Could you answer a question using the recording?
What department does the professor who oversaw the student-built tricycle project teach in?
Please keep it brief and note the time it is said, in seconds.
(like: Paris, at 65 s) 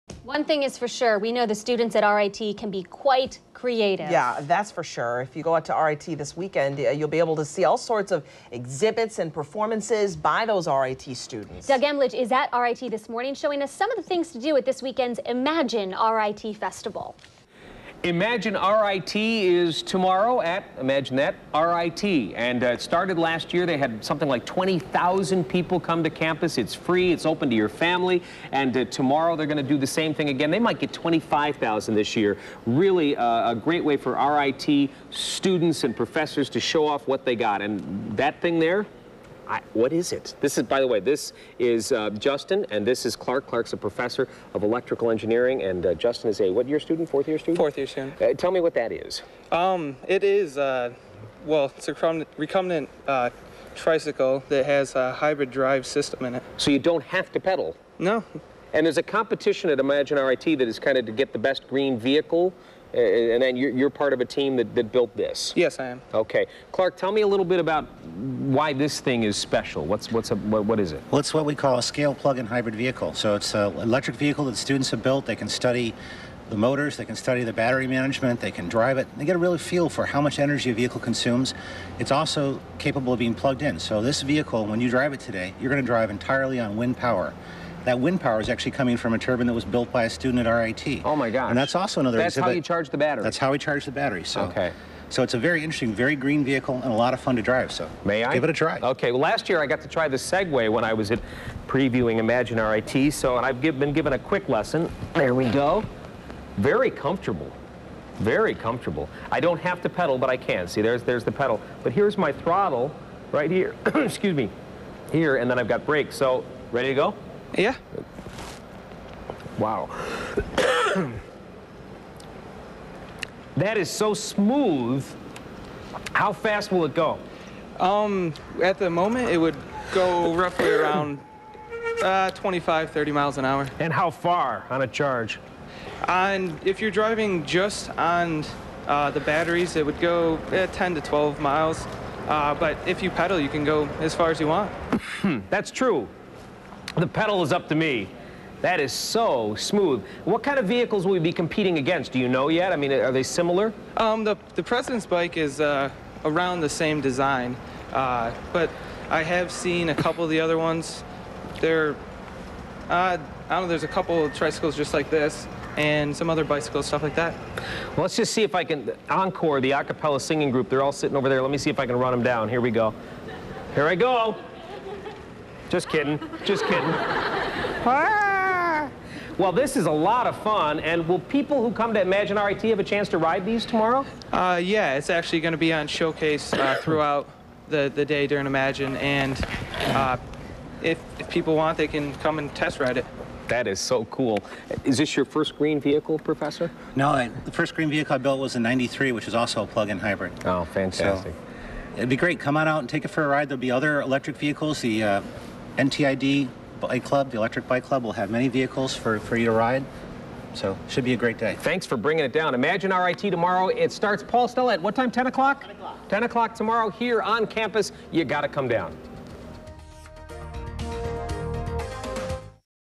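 electrical engineering, at 44 s.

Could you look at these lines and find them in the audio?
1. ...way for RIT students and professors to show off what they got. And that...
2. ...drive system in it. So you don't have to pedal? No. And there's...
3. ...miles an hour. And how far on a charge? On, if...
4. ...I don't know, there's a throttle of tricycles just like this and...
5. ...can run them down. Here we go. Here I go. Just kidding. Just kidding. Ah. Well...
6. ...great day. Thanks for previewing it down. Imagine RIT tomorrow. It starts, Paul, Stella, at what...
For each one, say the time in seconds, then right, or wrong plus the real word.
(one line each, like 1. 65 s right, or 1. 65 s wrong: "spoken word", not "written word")
1. 33 s right
2. 55 s right
3. 133 s right
4. 163 s wrong: "couple", not "throttle"
5. 171 s right
6. 211 s wrong: "bringing", not "previewing".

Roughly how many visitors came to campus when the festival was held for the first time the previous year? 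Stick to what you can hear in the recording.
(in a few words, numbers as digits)
20,000.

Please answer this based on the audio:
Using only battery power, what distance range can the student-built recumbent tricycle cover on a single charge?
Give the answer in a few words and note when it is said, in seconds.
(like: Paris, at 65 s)
10 to 12 miles, at 140 s.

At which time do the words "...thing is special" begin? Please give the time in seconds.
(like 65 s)
69 s.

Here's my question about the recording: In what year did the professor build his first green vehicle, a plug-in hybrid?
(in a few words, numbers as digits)
1993.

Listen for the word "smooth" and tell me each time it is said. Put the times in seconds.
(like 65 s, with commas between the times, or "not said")
124 s, 149 s.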